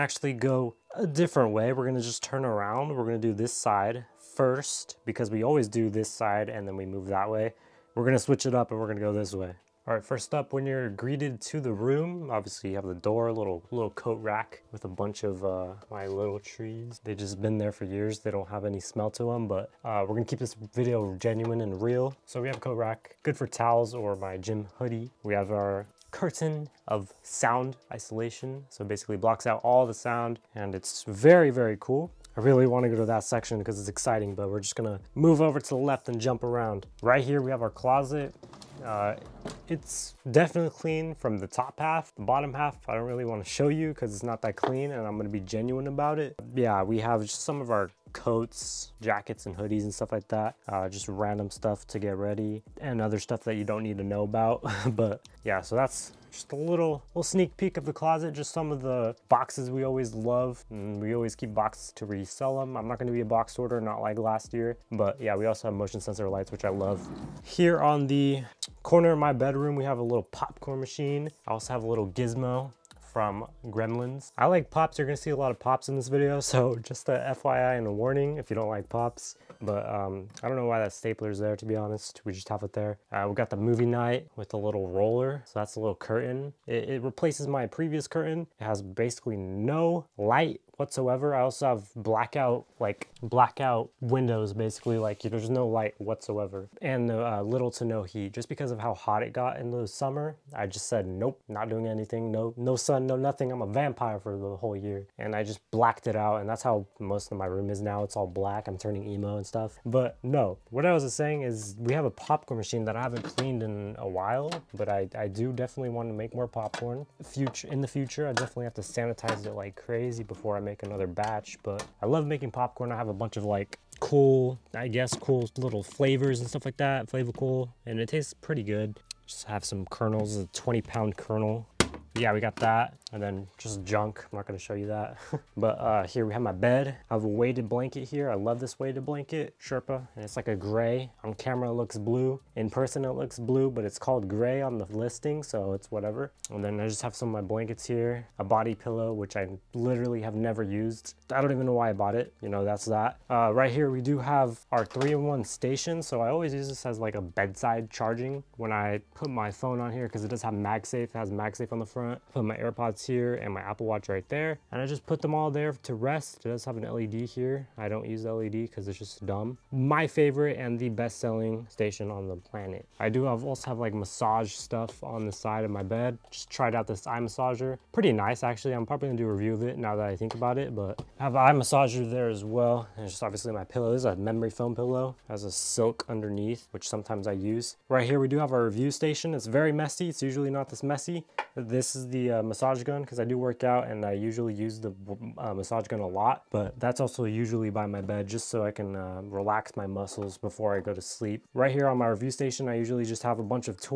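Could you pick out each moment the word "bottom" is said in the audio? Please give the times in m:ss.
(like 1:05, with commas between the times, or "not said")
0:42.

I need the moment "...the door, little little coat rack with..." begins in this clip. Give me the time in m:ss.
0:12.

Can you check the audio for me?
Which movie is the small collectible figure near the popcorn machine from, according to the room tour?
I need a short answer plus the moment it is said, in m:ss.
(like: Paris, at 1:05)
Gremlins, at 1:13.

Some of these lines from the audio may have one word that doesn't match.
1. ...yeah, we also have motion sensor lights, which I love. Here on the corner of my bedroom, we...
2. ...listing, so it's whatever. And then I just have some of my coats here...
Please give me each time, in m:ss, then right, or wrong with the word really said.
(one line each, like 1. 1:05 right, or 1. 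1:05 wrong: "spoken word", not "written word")
1. 1:05 right
2. 2:24 wrong: "blankets", not "coats".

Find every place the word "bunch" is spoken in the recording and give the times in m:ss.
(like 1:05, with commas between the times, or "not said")
0:14, 2:03, 3:23.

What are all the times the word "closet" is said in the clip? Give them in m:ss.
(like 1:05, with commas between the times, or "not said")
0:37, 0:57.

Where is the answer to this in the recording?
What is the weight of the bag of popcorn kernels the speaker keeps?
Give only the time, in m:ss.
2:10.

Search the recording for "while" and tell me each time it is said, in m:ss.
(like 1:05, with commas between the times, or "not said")
1:54.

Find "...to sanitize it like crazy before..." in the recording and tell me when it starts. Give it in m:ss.
1:58.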